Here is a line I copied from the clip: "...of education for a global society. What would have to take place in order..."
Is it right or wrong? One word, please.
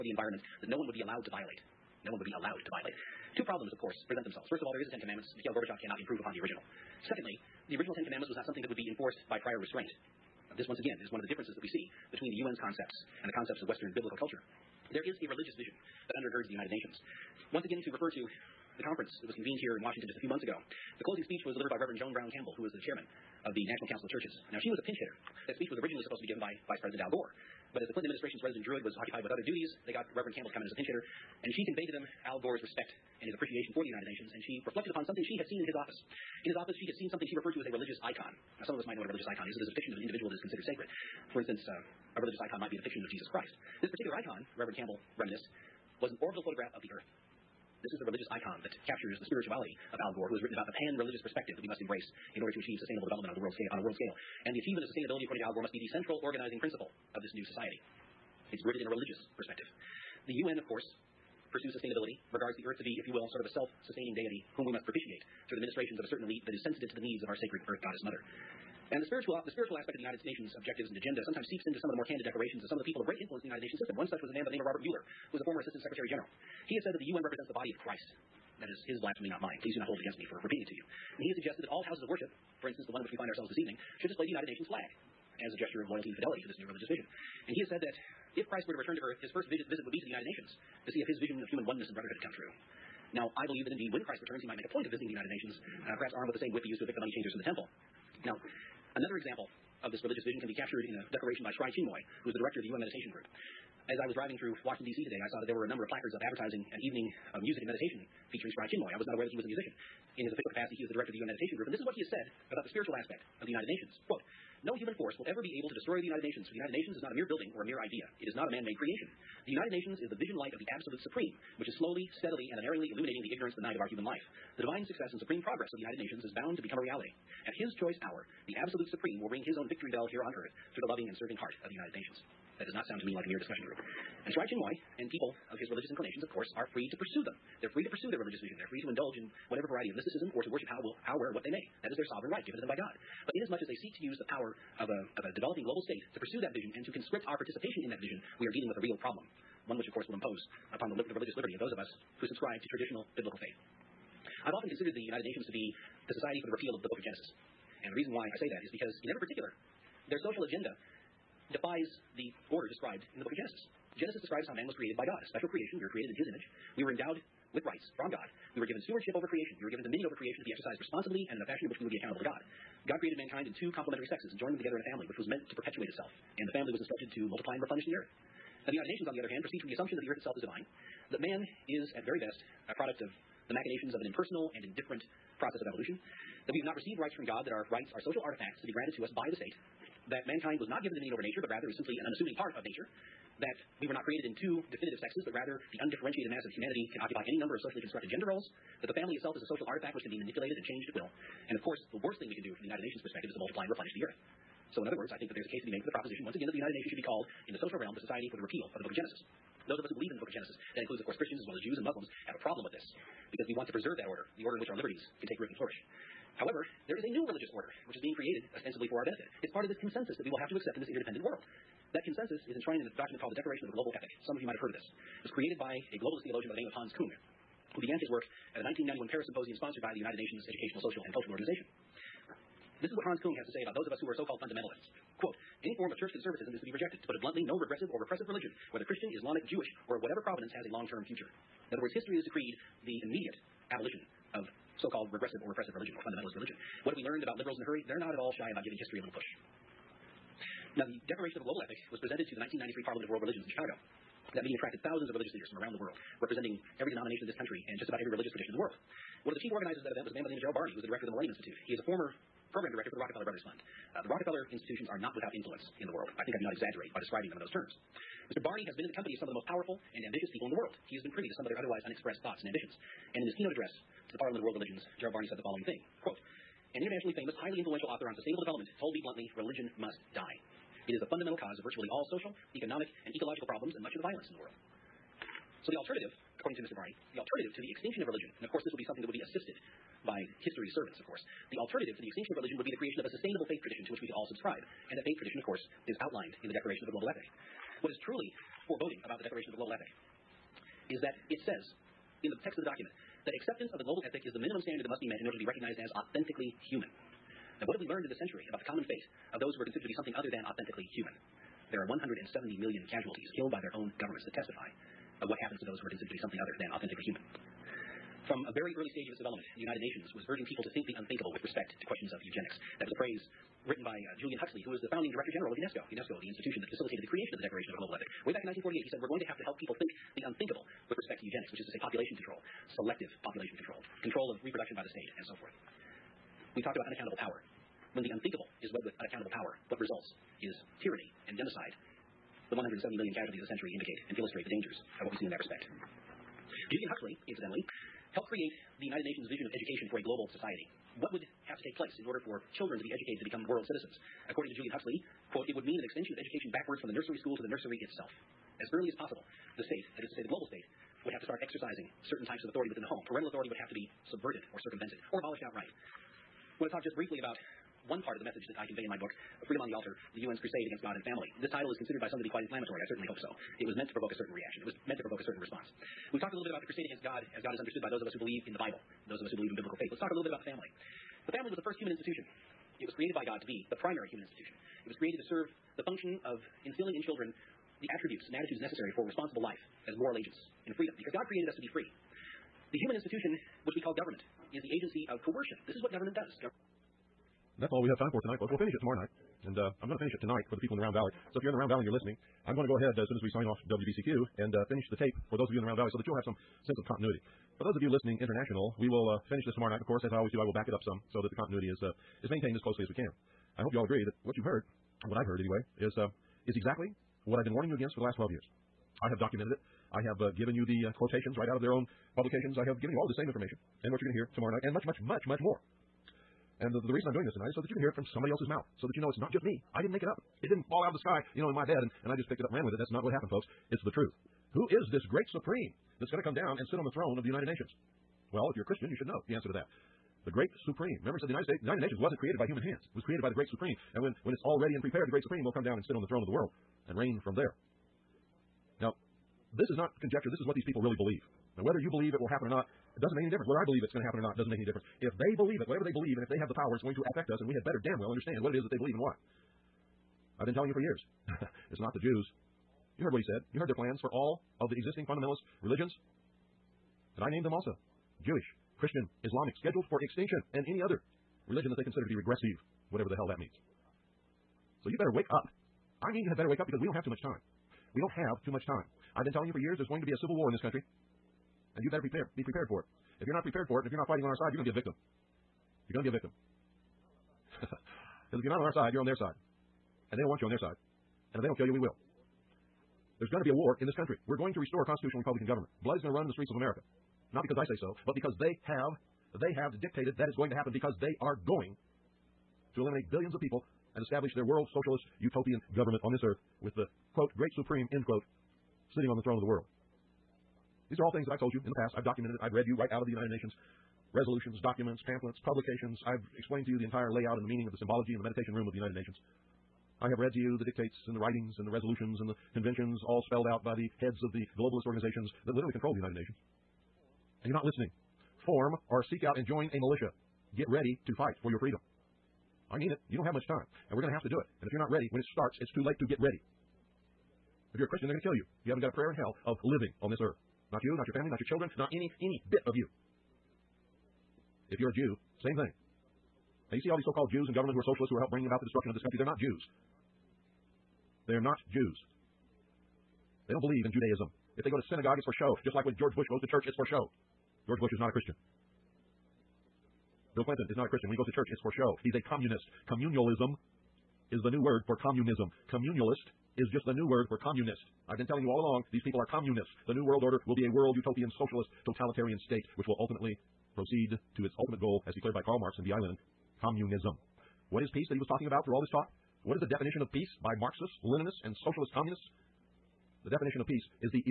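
right.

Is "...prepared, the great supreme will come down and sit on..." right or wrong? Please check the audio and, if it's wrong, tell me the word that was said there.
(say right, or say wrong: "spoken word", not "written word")
right.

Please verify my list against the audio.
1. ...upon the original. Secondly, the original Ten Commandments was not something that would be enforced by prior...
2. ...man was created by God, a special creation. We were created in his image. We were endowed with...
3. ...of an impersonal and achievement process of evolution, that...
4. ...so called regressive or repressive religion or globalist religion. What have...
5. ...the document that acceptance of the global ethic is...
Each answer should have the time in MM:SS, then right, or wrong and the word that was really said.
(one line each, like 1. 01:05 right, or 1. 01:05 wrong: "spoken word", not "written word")
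1. 00:06 right
2. 02:44 right
3. 03:03 wrong: "indifferent", not "achievement"
4. 04:04 wrong: "fundamentalist", not "globalist"
5. 05:02 right.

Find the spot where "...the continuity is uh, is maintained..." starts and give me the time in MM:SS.
06:51.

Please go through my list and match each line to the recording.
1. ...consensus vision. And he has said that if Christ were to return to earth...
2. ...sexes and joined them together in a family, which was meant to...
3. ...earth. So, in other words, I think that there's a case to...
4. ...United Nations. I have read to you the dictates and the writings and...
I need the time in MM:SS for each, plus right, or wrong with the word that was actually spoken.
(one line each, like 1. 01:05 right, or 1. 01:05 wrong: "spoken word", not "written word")
1. 01:26 wrong: "religious", not "consensus"
2. 02:54 right
3. 03:24 right
4. 08:38 right.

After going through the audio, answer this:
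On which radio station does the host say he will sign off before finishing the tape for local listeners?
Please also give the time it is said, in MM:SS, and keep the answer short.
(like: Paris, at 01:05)
WBCQ, at 06:43.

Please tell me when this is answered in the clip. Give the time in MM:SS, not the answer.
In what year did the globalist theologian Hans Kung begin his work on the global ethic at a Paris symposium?
03:48.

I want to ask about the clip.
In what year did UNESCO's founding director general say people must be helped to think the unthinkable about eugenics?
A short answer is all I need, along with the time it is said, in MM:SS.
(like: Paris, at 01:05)
1948, at 05:28.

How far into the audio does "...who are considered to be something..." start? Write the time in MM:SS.
05:15.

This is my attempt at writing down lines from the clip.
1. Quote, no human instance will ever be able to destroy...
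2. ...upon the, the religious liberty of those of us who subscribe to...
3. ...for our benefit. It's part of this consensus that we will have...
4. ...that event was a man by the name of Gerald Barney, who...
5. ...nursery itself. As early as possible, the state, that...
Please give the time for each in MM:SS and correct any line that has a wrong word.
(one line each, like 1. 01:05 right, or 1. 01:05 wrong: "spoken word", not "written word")
1. 01:54 wrong: "force", not "instance"
2. 02:30 right
3. 03:38 right
4. 04:19 right
5. 05:57 right.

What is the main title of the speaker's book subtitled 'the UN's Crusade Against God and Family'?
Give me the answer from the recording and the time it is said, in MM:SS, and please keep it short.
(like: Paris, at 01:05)
Freedom on the Altar, at 06:09.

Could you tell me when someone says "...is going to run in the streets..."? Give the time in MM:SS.
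08:15.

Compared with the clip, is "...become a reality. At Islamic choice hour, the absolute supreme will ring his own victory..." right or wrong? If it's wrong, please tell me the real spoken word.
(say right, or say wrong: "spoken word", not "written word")
wrong: "His", not "Islamic".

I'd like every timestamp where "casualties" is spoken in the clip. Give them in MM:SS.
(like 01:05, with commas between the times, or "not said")
05:12, 05:43.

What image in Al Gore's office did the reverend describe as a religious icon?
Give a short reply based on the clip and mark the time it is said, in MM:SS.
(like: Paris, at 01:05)
An orbital photograph of the earth, at 00:46.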